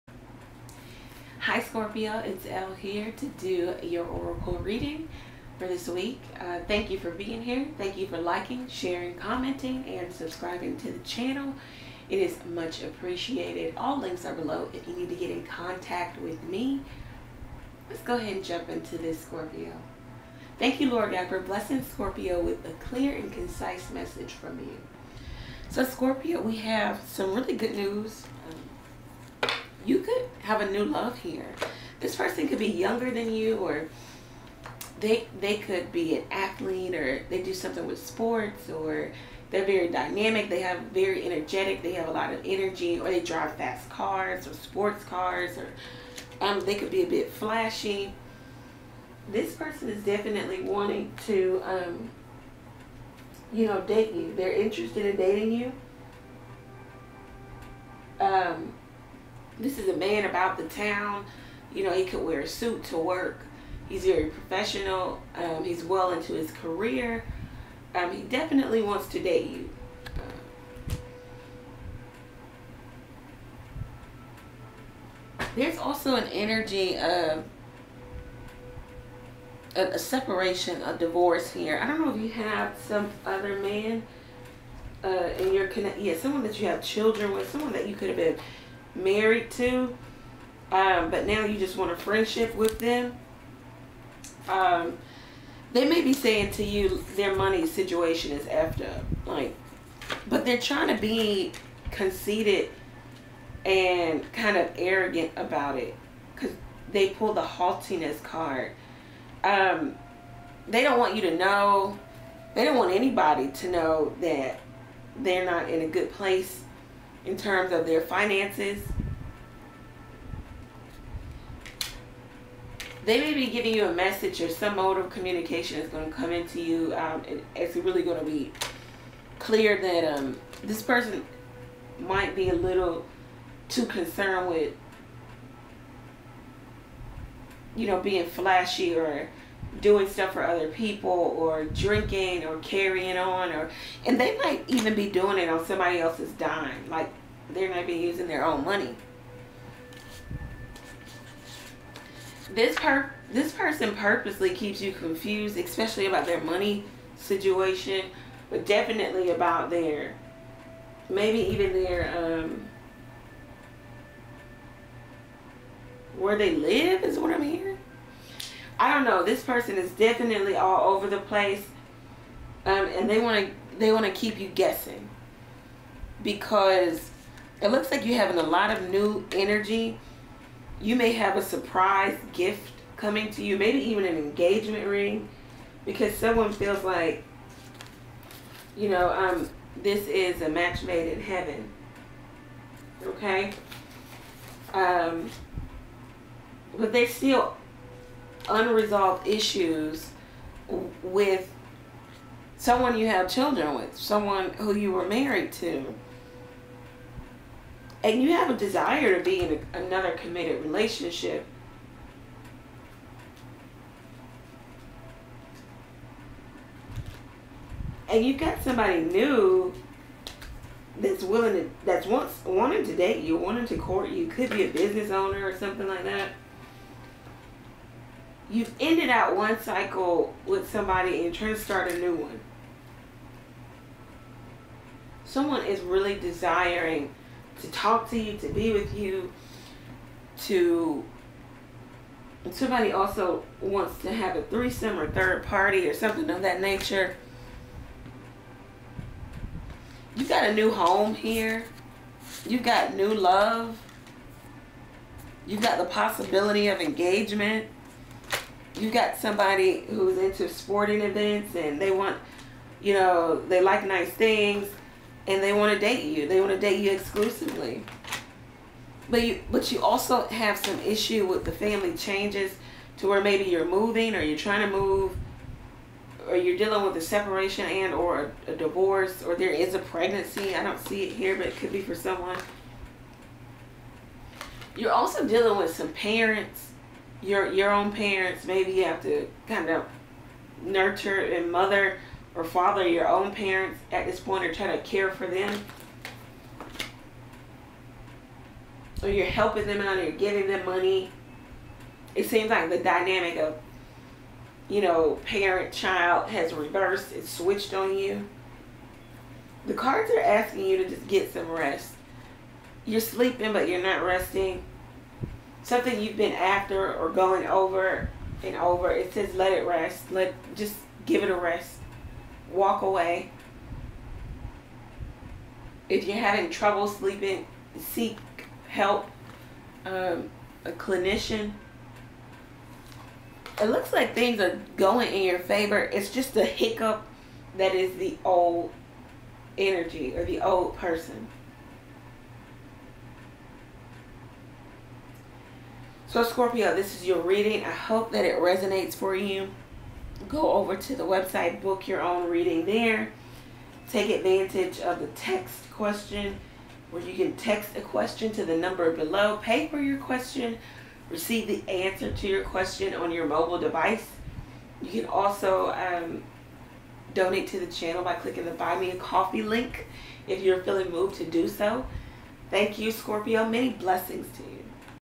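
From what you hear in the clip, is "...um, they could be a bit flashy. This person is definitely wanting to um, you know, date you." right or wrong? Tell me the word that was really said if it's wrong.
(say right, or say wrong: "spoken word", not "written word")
right.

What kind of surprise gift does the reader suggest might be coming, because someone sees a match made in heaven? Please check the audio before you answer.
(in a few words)
engagement ring.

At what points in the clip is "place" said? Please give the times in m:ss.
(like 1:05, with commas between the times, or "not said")
1:56, 2:51.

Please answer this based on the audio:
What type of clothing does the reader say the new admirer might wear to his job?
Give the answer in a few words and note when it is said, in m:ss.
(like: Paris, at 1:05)
a suit, at 1:02.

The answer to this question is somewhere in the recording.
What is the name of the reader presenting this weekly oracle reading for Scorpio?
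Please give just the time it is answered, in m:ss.
0:02.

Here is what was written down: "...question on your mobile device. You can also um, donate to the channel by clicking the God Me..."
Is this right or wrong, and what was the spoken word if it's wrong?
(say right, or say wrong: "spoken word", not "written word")
wrong: "Buy", not "God".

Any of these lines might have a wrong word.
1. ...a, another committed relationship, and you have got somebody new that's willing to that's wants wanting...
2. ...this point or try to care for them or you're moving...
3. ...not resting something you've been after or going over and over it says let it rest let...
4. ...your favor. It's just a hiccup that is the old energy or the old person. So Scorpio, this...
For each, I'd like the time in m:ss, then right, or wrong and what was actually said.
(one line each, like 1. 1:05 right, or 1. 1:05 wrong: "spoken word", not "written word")
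1. 3:29 right
2. 4:54 wrong: "helping", not "moving"
3. 5:13 right
4. 5:35 right.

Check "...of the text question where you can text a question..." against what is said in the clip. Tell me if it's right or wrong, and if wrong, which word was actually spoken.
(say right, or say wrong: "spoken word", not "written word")
right.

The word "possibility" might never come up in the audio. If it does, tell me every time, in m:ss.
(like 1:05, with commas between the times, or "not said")
4:15.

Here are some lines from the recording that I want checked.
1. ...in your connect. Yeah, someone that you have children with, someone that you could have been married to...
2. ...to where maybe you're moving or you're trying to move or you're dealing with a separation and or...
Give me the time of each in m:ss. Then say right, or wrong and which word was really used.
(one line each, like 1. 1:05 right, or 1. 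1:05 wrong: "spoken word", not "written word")
1. 1:25 right
2. 4:32 right.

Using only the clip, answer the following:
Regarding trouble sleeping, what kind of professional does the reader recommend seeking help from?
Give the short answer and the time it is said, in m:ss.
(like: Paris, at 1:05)
a clinician, at 5:30.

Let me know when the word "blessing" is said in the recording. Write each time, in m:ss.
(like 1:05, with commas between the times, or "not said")
0:21, 6:13.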